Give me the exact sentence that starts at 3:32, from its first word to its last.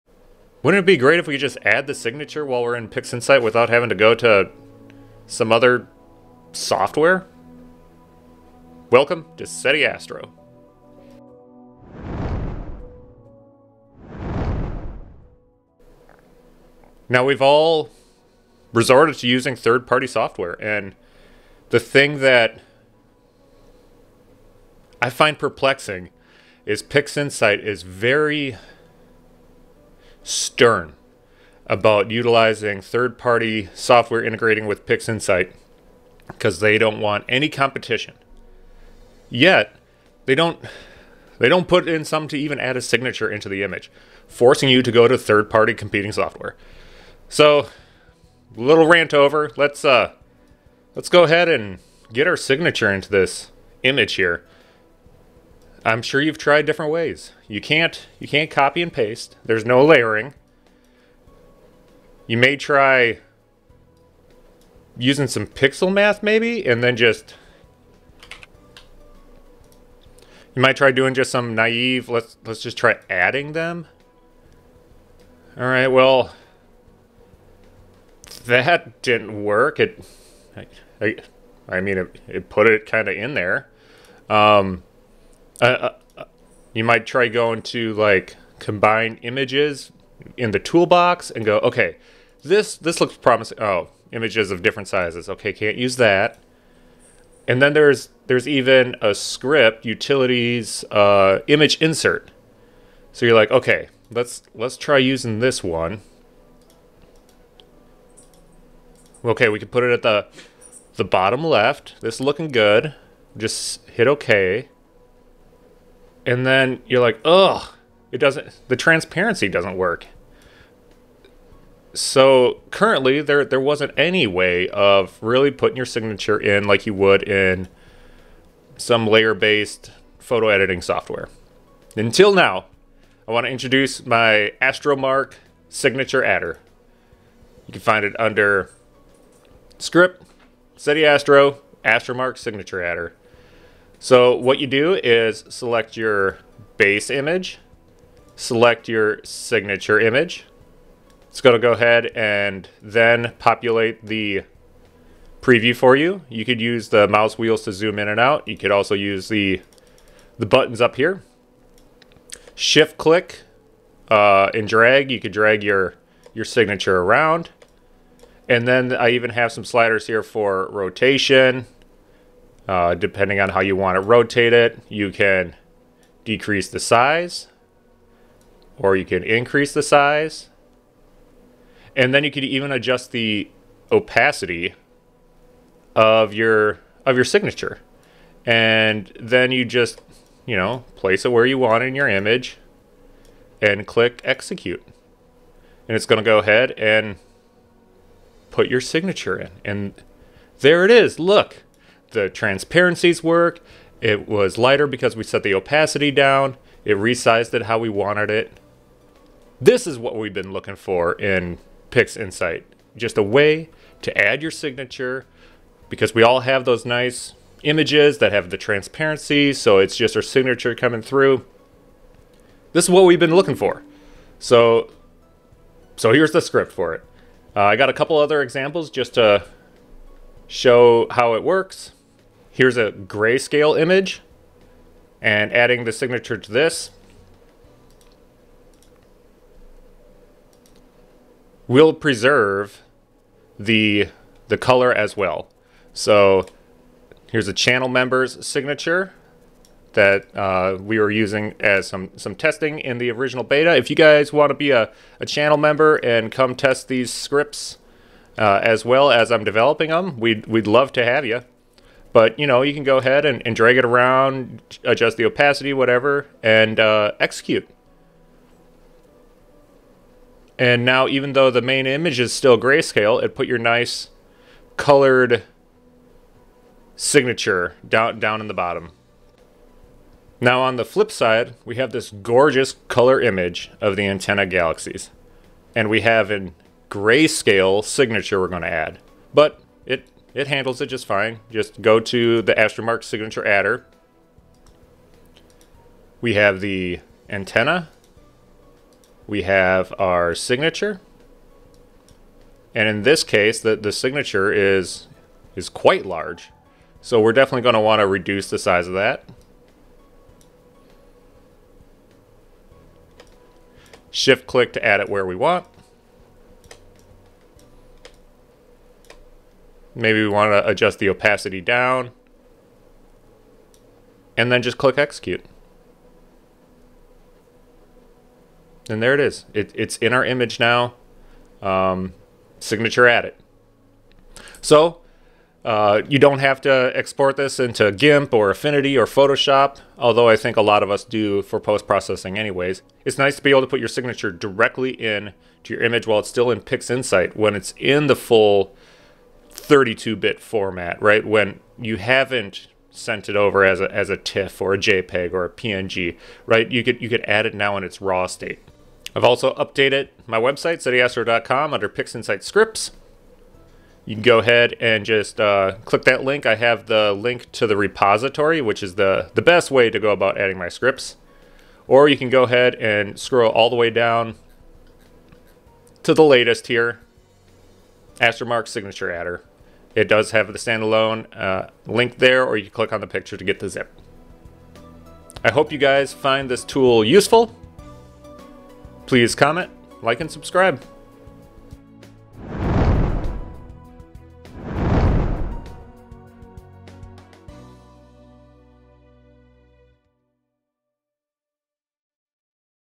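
Just a way to add your signature because we all have those nice images that have the transparency.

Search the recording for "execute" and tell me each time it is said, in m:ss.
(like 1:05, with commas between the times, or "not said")
3:14, 4:27, 5:24.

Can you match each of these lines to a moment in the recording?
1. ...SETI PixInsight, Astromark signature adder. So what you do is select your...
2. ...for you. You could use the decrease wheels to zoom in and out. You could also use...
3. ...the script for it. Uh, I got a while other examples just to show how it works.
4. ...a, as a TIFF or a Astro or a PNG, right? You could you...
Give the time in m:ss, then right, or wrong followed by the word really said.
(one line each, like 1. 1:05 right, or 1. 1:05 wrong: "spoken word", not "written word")
1. 2:20 wrong: "Astro", not "PixInsight"
2. 2:35 wrong: "mouse", not "decrease"
3. 3:46 wrong: "couple", not "while"
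4. 5:53 wrong: "JPEG", not "Astro".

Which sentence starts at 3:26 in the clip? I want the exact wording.
It resized it how we wanted it.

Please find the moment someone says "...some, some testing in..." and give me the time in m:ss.
4:11.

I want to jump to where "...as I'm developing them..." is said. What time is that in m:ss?
4:19.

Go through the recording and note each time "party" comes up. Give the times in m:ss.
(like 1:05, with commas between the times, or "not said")
0:19, 0:33, 0:45.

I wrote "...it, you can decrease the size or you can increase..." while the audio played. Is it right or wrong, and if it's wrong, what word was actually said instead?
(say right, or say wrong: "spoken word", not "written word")
right.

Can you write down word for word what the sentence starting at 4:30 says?
And now, even though the main image is still grayscale, it put your nice colored signature down down in the bottom.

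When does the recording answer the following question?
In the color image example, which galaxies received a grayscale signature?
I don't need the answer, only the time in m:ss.
4:44.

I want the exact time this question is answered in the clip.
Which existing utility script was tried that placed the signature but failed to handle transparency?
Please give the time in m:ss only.
1:41.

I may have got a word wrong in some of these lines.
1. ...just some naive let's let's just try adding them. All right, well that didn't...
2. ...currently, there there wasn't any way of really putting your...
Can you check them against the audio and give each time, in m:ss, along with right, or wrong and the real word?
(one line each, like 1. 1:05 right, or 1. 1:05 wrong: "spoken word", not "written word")
1. 1:11 right
2. 2:02 right.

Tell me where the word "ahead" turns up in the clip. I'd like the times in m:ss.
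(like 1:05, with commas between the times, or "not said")
0:51, 2:31, 3:16, 4:22, 6:04, 6:12.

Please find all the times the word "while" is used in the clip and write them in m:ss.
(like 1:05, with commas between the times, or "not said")
0:02, 5:46.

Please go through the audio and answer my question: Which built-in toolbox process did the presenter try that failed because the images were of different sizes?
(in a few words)
Combine images.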